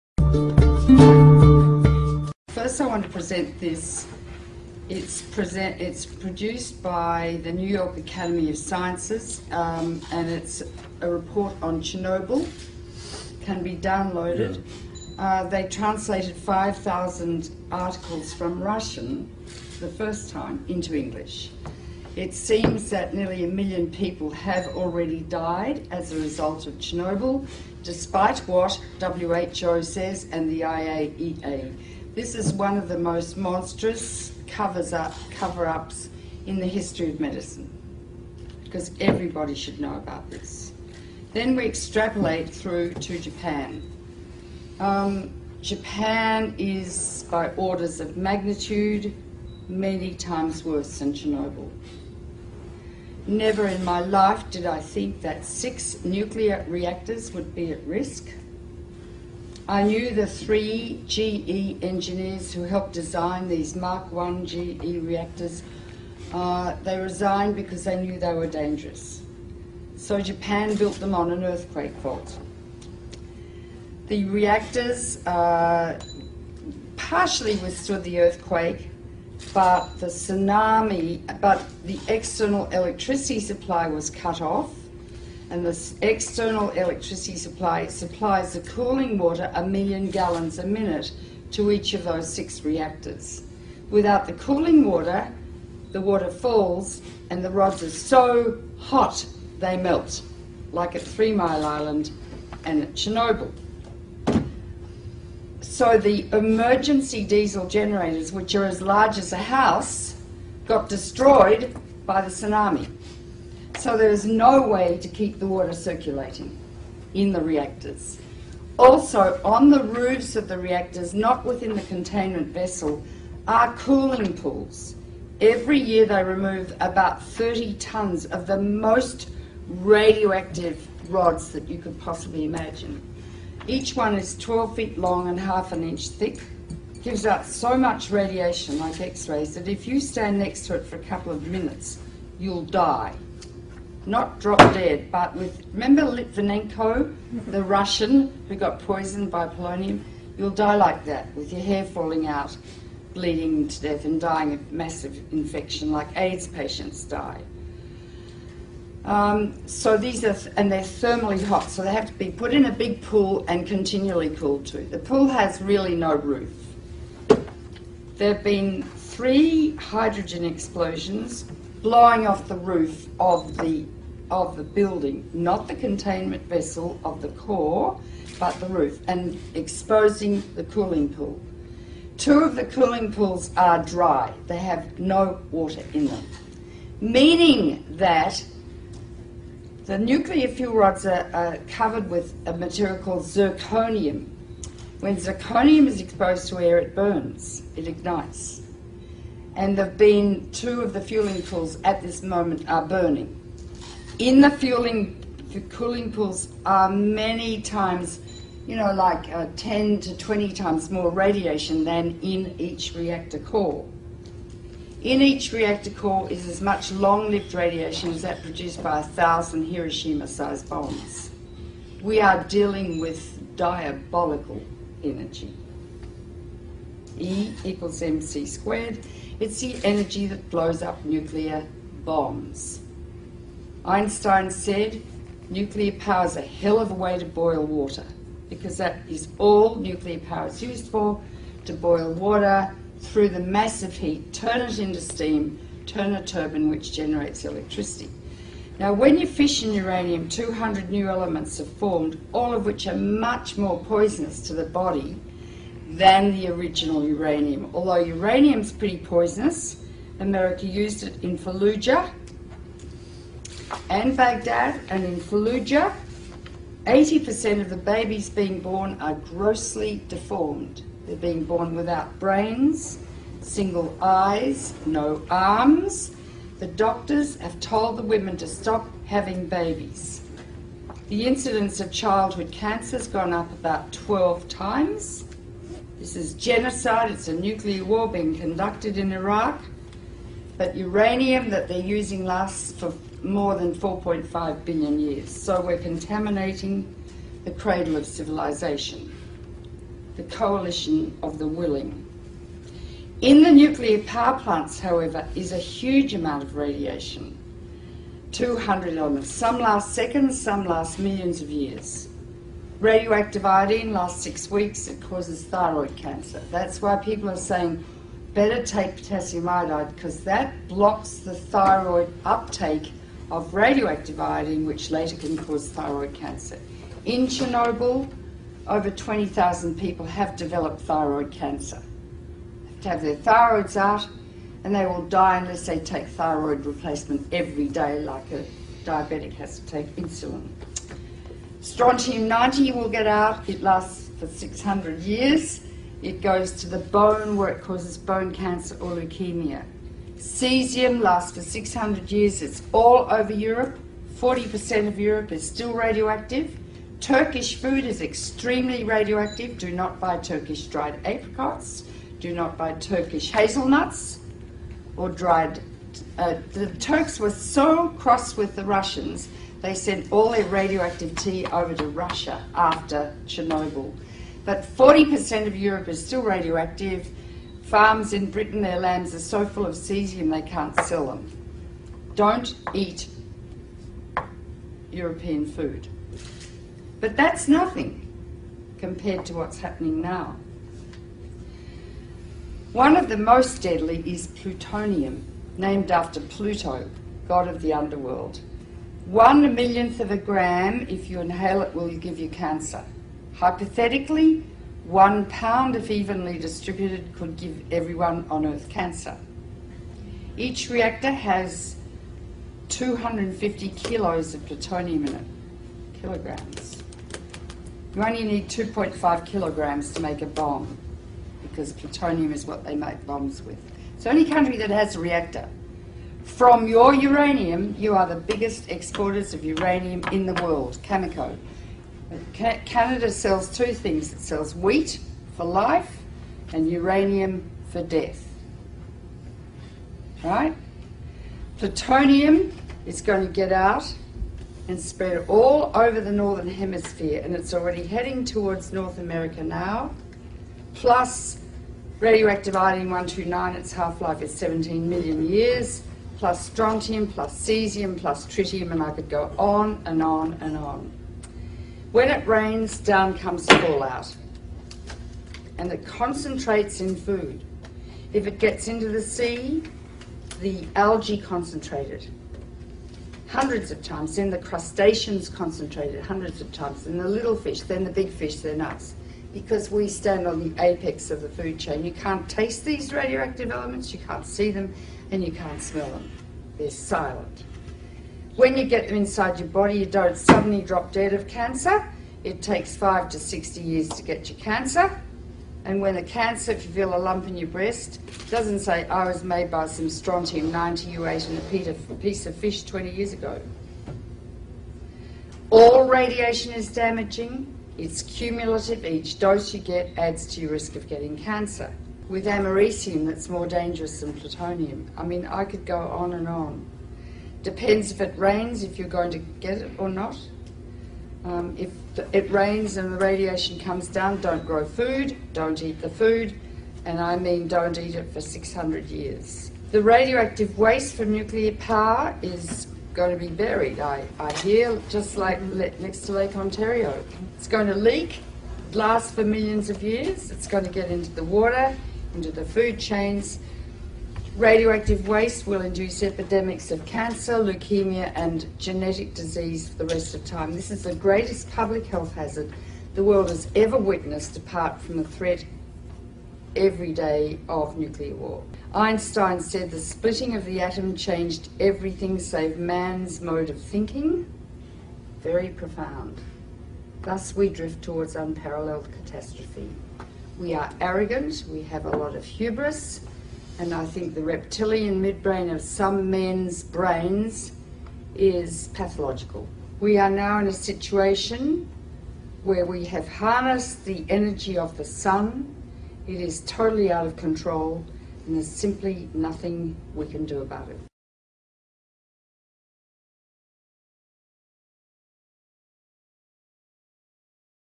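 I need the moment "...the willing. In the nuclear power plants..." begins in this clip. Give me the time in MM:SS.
05:01.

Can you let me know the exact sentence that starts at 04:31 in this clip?
They're being born without brains, single eyes, no arms.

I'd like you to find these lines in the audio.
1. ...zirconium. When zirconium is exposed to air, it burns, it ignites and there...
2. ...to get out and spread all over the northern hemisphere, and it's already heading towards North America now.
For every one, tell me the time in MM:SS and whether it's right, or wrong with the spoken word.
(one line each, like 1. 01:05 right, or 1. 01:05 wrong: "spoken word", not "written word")
1. 03:13 right
2. 07:23 right.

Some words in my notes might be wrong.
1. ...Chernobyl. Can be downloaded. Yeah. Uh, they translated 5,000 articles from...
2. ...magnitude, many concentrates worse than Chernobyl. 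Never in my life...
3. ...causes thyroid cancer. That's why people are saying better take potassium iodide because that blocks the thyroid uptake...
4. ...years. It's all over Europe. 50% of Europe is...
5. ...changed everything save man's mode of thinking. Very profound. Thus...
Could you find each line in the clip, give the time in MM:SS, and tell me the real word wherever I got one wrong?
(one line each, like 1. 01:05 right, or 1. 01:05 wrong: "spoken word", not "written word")
1. 00:11 right
2. 00:48 wrong: "times", not "concentrates"
3. 05:15 right
4. 05:52 wrong: "40", not "50"
5. 09:20 right.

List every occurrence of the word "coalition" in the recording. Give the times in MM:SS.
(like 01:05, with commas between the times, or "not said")
05:00.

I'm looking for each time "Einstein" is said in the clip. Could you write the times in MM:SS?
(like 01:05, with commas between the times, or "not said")
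03:53, 09:18.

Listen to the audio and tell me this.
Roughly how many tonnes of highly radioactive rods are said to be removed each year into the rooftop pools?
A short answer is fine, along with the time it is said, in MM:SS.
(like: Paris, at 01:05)
30 tonnes, at 02:07.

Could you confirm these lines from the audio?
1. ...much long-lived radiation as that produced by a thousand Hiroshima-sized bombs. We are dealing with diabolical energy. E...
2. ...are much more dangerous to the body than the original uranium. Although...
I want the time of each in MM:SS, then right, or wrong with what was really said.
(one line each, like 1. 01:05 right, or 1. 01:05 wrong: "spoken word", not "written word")
1. 03:36 right
2. 04:12 wrong: "poisonous", not "dangerous".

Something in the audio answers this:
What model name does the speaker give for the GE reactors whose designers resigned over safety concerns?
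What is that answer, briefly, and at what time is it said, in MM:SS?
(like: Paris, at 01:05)
Mark 1, at 01:03.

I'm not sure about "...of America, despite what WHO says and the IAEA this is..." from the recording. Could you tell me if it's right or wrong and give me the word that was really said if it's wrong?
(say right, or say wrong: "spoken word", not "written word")
wrong: "Chernobyl", not "America".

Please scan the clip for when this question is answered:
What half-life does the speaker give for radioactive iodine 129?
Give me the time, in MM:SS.
07:34.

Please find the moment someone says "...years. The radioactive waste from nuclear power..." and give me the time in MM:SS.
08:48.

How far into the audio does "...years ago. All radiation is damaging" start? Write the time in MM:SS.
08:22.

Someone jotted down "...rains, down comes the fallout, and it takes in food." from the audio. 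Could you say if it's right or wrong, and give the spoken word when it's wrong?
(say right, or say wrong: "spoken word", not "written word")
wrong: "concentrates", not "takes".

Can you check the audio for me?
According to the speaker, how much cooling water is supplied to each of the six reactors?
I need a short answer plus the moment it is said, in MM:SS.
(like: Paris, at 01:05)
a million gallons a minute, at 01:29.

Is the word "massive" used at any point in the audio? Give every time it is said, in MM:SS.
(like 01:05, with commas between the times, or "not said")
02:34, 04:03.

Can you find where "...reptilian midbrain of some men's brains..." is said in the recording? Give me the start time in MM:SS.
09:34.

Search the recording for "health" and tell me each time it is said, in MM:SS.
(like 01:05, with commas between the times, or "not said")
09:11.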